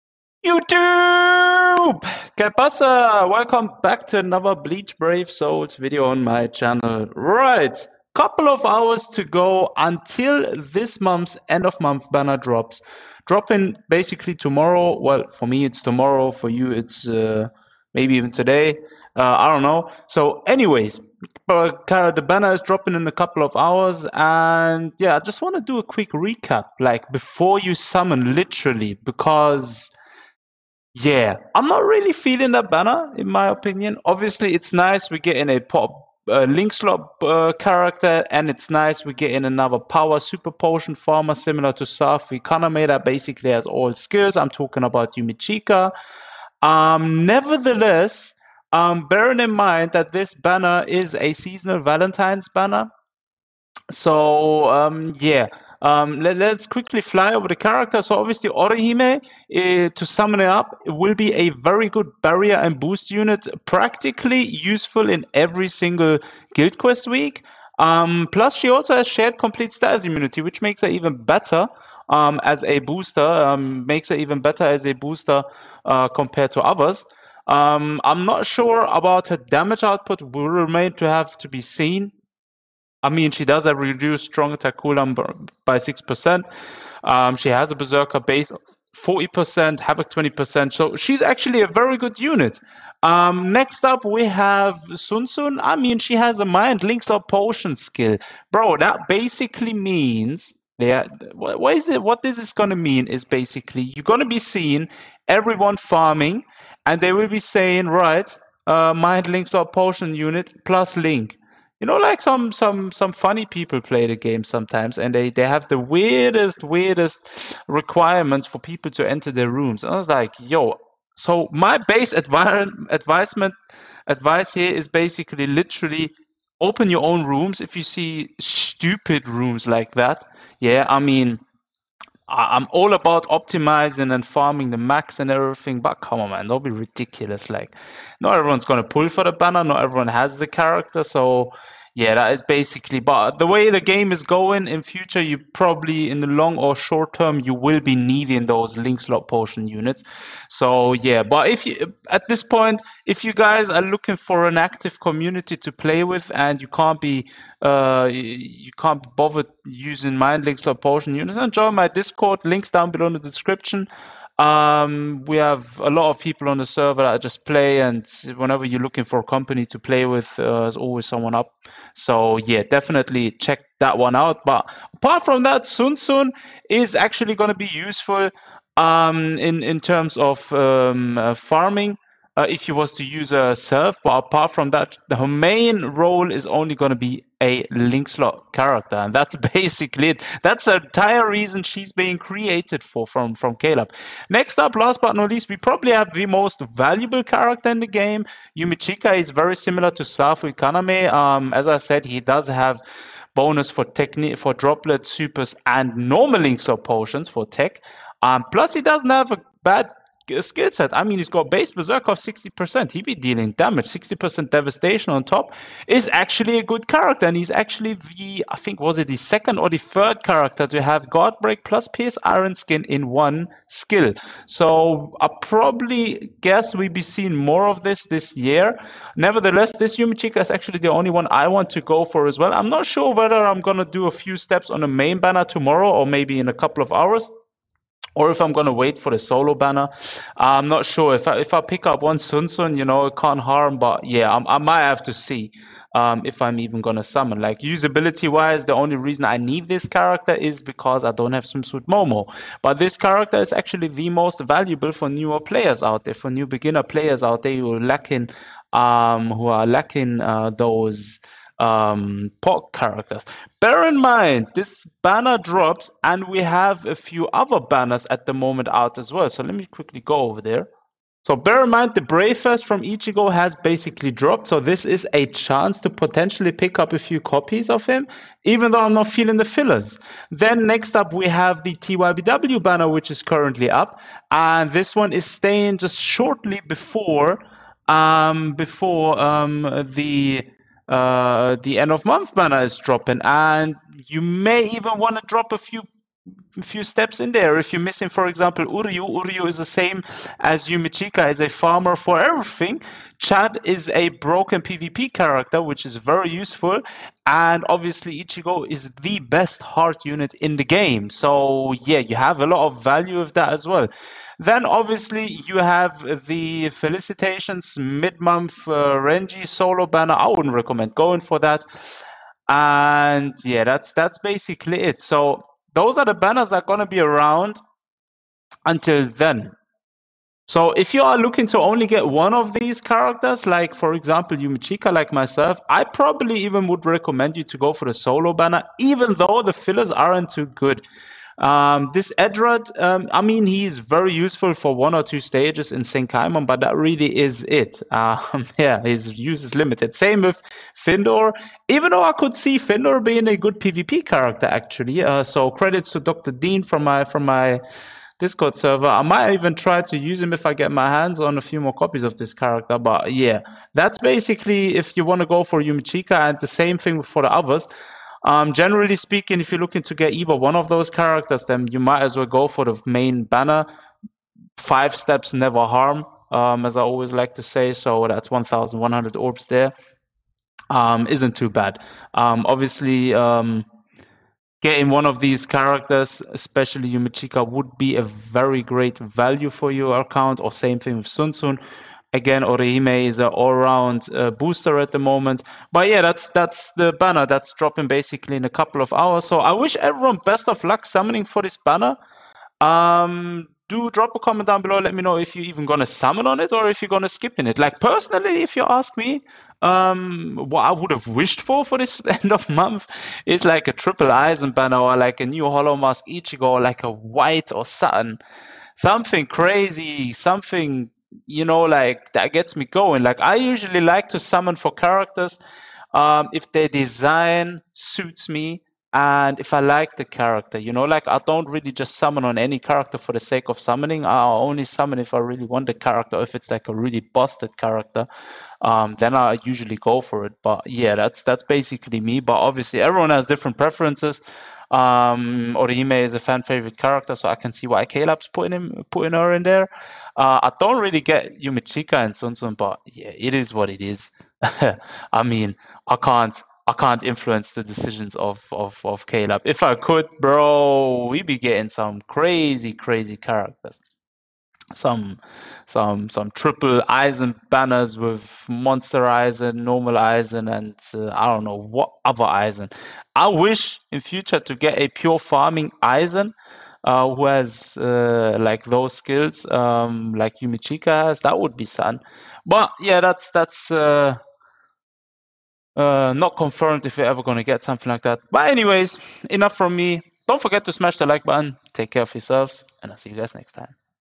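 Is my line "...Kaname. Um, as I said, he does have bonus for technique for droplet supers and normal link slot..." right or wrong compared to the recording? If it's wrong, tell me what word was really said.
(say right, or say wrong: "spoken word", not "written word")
right.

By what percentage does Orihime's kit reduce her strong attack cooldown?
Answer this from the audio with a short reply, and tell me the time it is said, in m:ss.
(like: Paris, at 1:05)
6%, at 1:25.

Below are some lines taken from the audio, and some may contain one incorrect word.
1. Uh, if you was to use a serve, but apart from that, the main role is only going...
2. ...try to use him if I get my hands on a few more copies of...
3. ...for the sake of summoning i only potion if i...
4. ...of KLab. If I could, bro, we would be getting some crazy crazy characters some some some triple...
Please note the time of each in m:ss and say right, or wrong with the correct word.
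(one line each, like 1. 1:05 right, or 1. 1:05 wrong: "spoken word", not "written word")
1. 3:02 right
2. 5:59 right
3. 7:12 wrong: "summon", not "potion"
4. 7:38 right.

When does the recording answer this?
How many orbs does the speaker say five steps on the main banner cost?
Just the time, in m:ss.
6:18.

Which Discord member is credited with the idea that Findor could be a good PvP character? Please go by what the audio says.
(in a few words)
Dr. Dean.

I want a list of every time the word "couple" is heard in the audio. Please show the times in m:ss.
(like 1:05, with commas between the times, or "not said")
0:08, 0:23, 3:56, 6:38.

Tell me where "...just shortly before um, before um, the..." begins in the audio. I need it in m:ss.
4:45.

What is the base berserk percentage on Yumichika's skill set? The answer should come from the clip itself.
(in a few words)
60%.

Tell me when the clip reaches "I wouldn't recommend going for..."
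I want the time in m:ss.
5:20.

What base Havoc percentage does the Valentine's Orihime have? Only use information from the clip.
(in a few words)
20%.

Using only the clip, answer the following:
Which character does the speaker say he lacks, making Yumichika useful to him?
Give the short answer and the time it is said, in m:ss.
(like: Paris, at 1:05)
Swimsuit Momo, at 4:11.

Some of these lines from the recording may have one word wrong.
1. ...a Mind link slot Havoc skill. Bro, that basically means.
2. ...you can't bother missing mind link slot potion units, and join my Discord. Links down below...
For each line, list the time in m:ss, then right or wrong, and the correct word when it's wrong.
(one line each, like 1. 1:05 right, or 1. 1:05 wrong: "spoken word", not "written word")
1. 1:36 wrong: "Potion", not "Havoc"
2. 2:38 wrong: "using", not "missing".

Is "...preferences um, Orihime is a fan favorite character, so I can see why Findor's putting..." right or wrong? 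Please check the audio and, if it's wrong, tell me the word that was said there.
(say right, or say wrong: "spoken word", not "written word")
wrong: "KLab", not "Findor".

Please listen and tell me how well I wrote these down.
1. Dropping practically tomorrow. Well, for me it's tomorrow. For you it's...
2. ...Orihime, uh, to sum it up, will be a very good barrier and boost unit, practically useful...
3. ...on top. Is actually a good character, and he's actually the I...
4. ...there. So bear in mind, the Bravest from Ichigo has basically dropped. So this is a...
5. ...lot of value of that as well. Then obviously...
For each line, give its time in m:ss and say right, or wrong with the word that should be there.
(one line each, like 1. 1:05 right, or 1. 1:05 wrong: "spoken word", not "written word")
1. 0:13 wrong: "basically", not "practically"
2. 0:58 right
3. 3:35 right
4. 4:30 right
5. 5:12 right.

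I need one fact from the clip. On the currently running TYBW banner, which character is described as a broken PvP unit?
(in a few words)
Chad.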